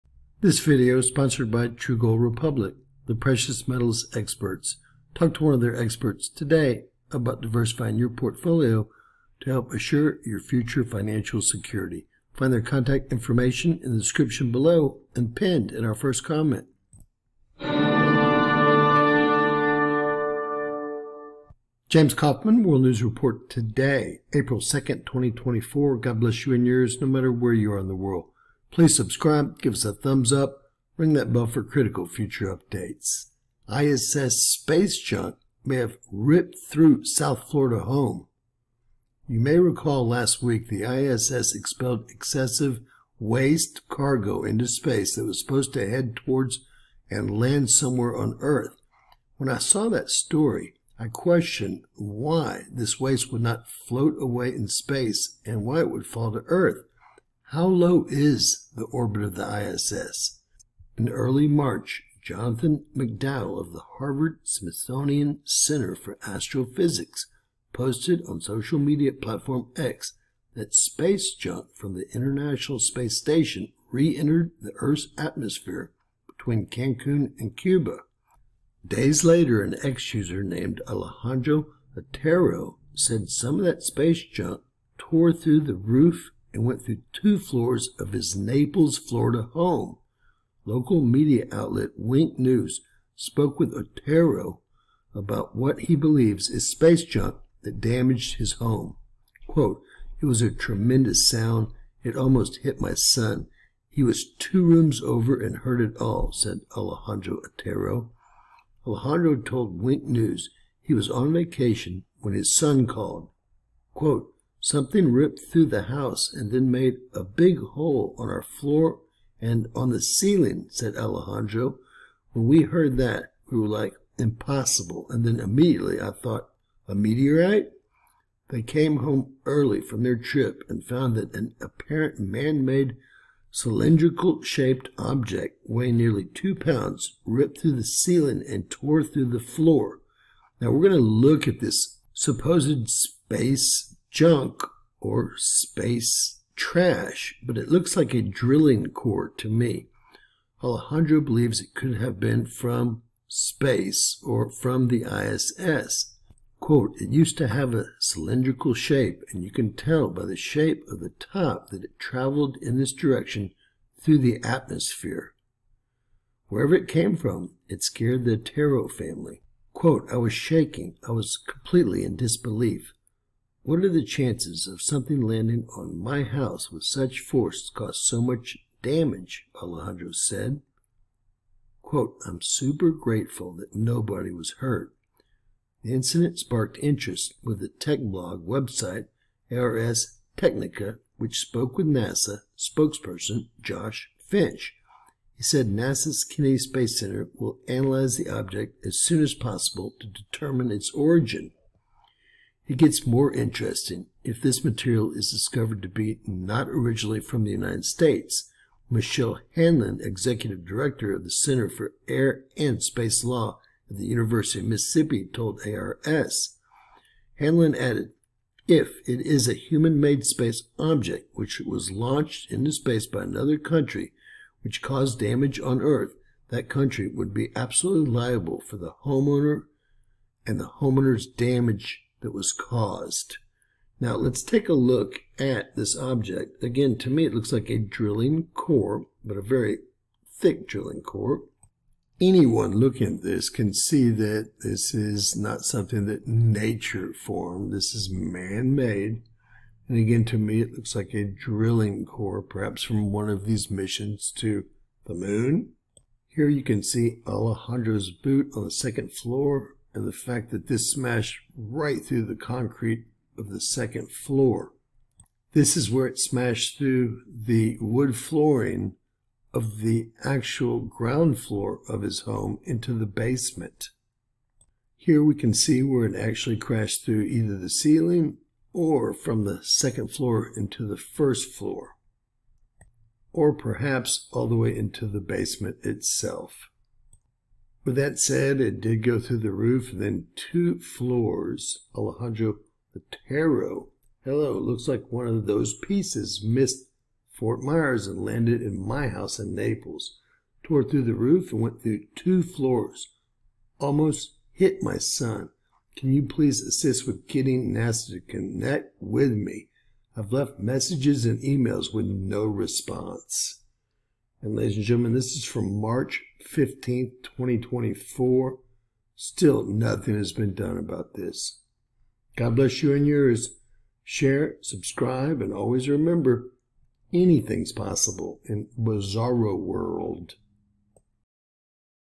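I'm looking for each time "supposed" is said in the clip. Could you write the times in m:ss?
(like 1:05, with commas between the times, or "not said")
0:45, 2:22.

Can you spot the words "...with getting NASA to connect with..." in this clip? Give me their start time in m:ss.
5:07.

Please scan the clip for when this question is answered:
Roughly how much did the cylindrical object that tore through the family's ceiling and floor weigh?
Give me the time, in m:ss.
2:15.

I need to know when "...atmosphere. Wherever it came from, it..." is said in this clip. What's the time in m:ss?
2:44.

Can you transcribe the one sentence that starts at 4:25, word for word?
This is where it smashed through the wood flooring of the actual ground floor of his home into the basement.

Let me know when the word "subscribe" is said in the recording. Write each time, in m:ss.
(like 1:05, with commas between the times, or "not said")
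0:28, 5:24.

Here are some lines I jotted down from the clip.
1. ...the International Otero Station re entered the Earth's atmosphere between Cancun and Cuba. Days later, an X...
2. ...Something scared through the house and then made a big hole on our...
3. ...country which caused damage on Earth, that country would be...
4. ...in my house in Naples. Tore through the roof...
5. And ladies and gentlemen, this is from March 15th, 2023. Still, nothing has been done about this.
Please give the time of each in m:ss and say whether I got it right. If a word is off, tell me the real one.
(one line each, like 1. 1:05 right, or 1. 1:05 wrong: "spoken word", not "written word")
1. 1:11 wrong: "Space", not "Otero"
2. 1:54 wrong: "ripped", not "scared"
3. 3:43 right
4. 4:58 right
5. 5:14 wrong: "2024", not "2023".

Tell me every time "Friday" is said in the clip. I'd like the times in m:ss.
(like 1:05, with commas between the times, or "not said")
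not said.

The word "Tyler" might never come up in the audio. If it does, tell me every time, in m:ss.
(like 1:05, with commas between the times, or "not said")
not said.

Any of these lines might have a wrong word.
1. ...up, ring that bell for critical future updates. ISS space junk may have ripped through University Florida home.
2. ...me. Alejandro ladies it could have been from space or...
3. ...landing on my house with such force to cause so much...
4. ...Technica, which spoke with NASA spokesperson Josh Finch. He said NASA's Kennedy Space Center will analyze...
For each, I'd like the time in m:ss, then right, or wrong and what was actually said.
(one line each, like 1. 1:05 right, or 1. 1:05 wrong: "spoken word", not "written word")
1. 0:30 wrong: "South", not "University"
2. 2:29 wrong: "believes", not "ladies"
3. 2:55 right
4. 3:10 right.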